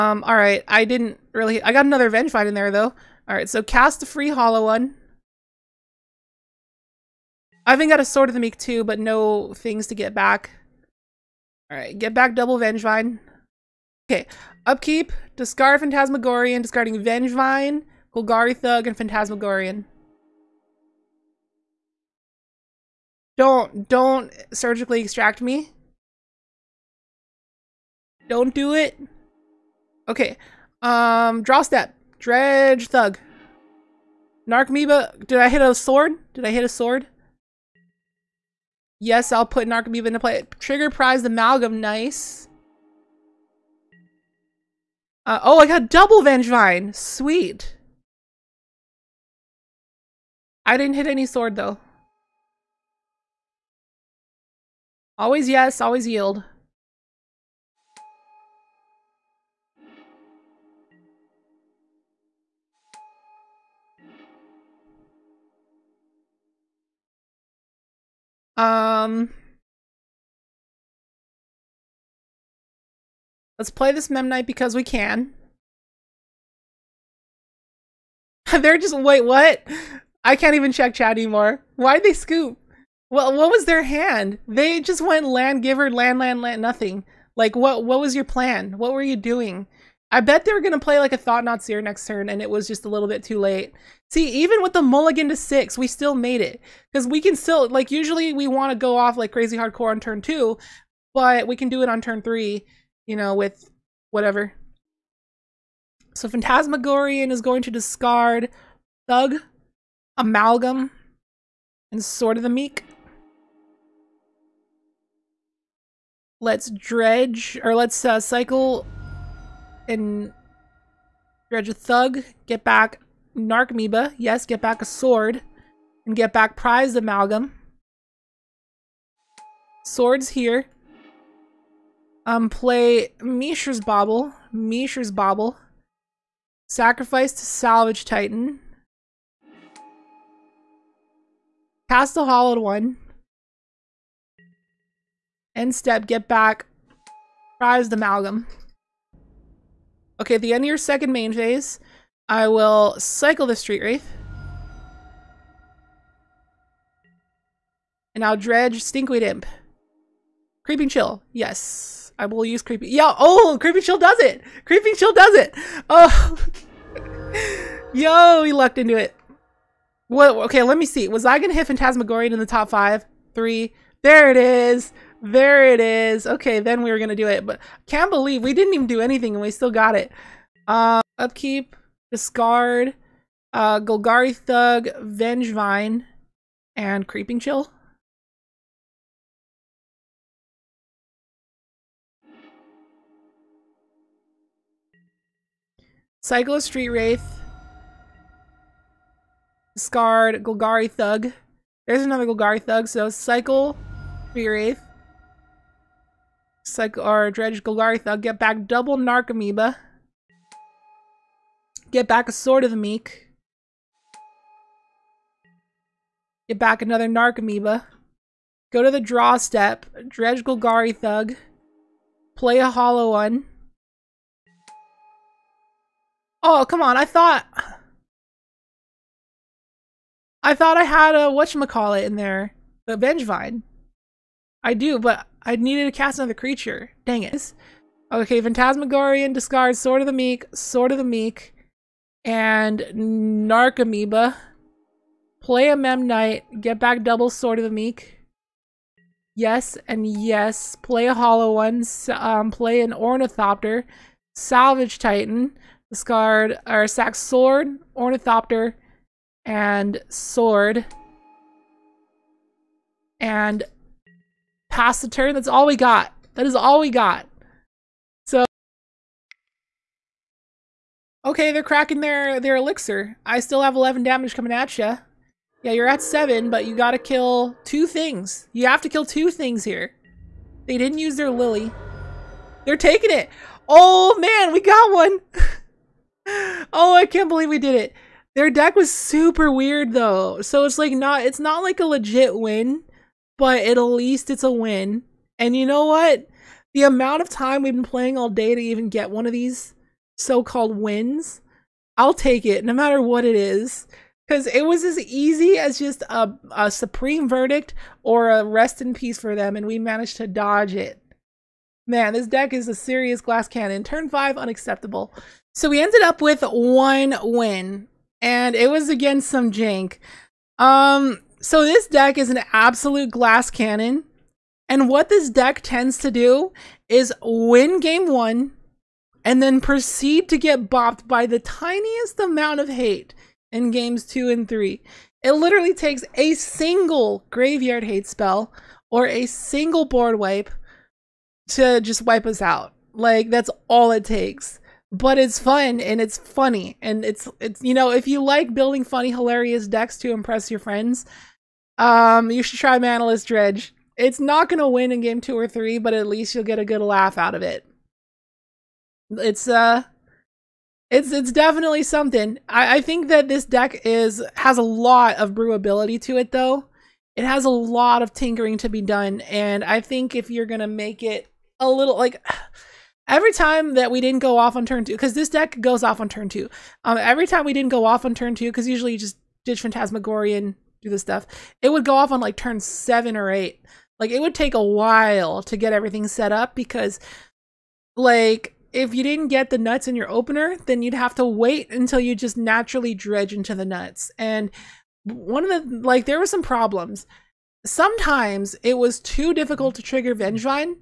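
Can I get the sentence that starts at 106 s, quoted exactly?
So Phantasmagorian is going to discard Thug, Amalgam, and Sword of the Meek.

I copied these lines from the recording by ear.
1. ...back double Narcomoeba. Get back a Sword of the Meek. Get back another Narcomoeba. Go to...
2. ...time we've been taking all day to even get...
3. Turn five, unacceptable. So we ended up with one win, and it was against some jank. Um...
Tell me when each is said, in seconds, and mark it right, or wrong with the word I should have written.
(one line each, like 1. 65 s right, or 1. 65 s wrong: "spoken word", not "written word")
1. 208 s right
2. 297 s wrong: "playing", not "taking"
3. 313 s right.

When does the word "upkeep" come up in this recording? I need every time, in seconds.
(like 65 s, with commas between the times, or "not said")
14 s, 181 s.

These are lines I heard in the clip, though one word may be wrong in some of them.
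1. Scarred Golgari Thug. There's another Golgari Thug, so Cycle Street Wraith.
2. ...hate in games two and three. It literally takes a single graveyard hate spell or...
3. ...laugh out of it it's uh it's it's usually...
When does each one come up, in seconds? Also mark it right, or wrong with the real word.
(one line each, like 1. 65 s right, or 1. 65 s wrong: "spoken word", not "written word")
1. 199 s right
2. 332 s right
3. 356 s wrong: "definitely", not "usually".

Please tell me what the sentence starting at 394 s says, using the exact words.
And one of the like, there were some problems.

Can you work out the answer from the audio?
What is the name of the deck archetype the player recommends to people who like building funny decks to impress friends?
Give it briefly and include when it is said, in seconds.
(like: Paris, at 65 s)
manaless dredge, at 352 s.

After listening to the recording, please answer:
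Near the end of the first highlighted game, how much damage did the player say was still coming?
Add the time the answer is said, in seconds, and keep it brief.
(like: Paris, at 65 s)
11, at 273 s.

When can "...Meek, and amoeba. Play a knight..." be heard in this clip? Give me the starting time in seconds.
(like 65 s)
241 s.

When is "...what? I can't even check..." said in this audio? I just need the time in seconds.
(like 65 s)
79 s.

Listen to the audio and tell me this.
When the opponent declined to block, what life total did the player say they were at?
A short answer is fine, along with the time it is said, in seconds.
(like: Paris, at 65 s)
7, at 275 s.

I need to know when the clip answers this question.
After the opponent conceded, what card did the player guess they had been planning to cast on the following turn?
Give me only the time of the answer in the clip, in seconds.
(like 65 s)
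91 s.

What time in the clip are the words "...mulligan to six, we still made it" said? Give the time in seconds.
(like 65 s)
94 s.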